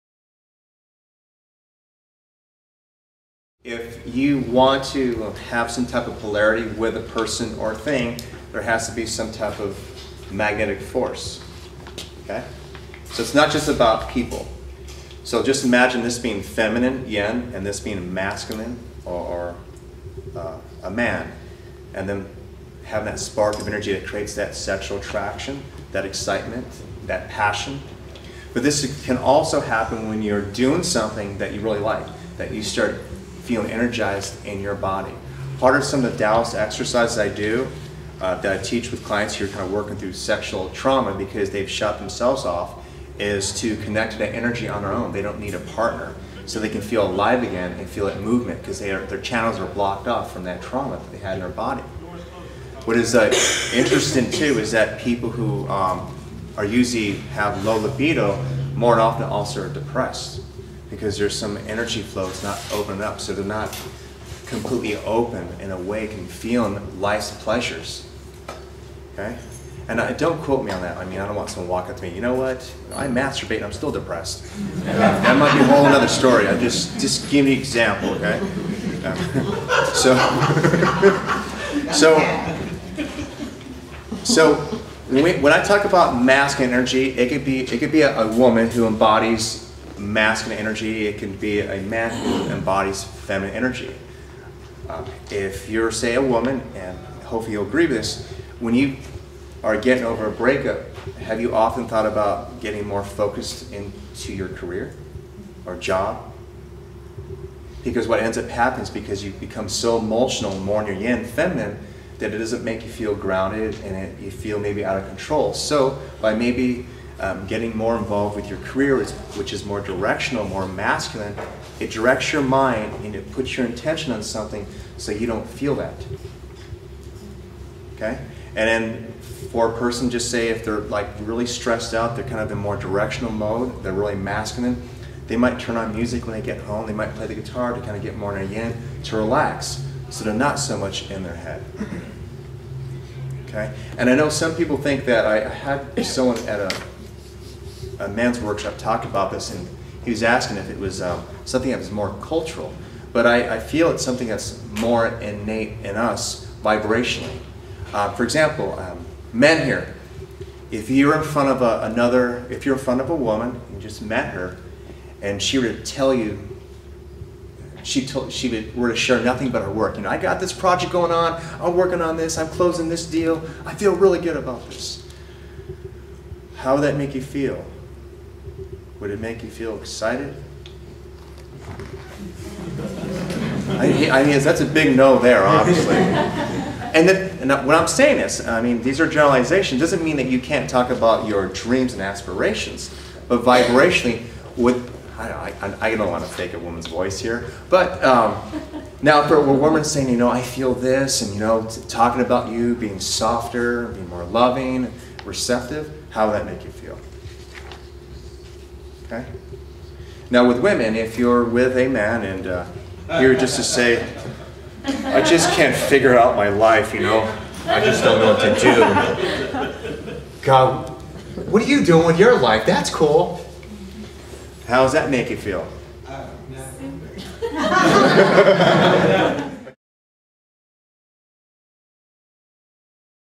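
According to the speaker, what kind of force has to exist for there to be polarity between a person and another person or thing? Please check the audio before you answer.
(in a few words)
magnetic force.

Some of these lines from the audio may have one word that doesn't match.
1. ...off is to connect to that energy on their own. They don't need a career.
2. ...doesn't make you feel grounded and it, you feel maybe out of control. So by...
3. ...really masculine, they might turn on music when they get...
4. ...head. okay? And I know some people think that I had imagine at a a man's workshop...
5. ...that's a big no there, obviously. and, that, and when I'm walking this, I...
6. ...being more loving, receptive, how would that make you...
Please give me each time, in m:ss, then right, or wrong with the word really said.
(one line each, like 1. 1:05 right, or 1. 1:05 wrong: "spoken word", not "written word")
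1. 0:42 wrong: "partner", not "career"
2. 1:52 right
3. 2:13 right
4. 2:21 wrong: "someone", not "imagine"
5. 3:04 wrong: "saying", not "walking"
6. 3:23 right.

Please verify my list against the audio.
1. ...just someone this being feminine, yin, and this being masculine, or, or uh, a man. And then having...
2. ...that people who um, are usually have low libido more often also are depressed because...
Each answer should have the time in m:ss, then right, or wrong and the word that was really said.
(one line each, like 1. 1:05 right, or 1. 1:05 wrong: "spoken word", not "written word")
1. 0:15 wrong: "imagine", not "someone"
2. 0:54 right.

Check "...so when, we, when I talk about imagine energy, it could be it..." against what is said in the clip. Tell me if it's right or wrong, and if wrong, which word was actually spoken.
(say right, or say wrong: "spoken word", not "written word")
wrong: "masculine", not "imagine".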